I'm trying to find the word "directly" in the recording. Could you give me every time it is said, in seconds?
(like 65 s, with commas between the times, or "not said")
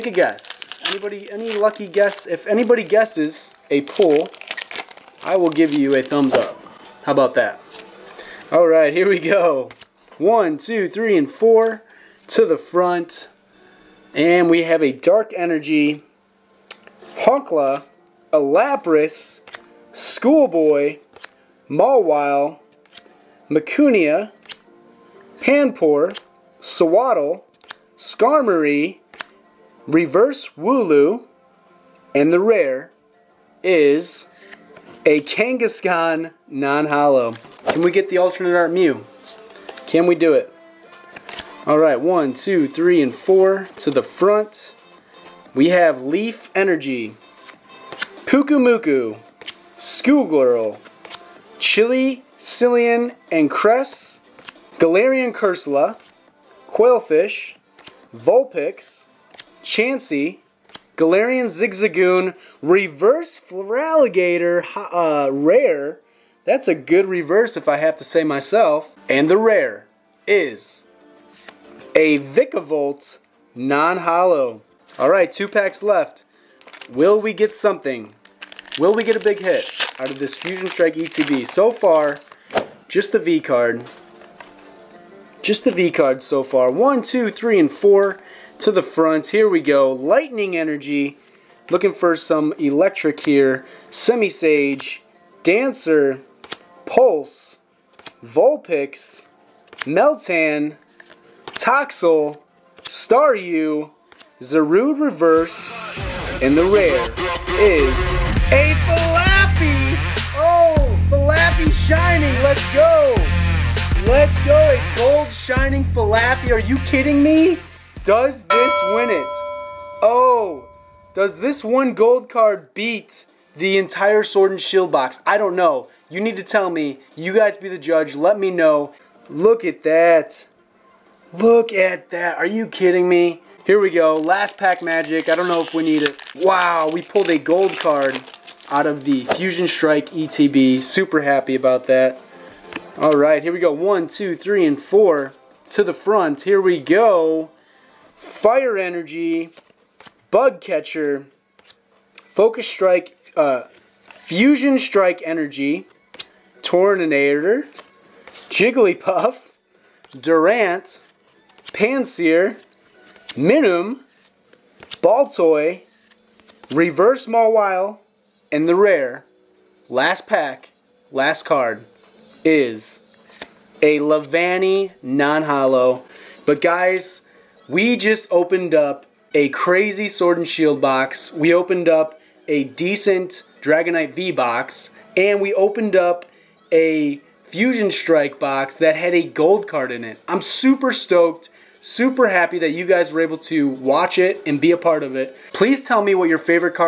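not said.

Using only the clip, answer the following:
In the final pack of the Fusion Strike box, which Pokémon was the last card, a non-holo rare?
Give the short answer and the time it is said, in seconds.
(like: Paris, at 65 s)
Leavanny, at 173 s.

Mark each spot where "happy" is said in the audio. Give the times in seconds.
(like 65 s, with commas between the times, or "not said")
141 s, 192 s.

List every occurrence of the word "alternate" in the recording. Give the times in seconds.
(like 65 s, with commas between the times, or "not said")
38 s.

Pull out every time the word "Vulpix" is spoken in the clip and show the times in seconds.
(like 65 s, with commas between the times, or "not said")
58 s, 98 s.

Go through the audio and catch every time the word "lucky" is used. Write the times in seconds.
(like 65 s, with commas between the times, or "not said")
1 s.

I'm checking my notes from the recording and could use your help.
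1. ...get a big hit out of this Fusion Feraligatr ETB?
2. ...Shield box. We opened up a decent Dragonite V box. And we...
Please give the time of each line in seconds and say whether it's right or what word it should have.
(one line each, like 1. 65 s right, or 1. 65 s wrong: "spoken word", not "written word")
1. 79 s wrong: "Strike", not "Feraligatr"
2. 180 s right.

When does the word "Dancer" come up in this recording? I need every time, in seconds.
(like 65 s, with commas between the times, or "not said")
95 s.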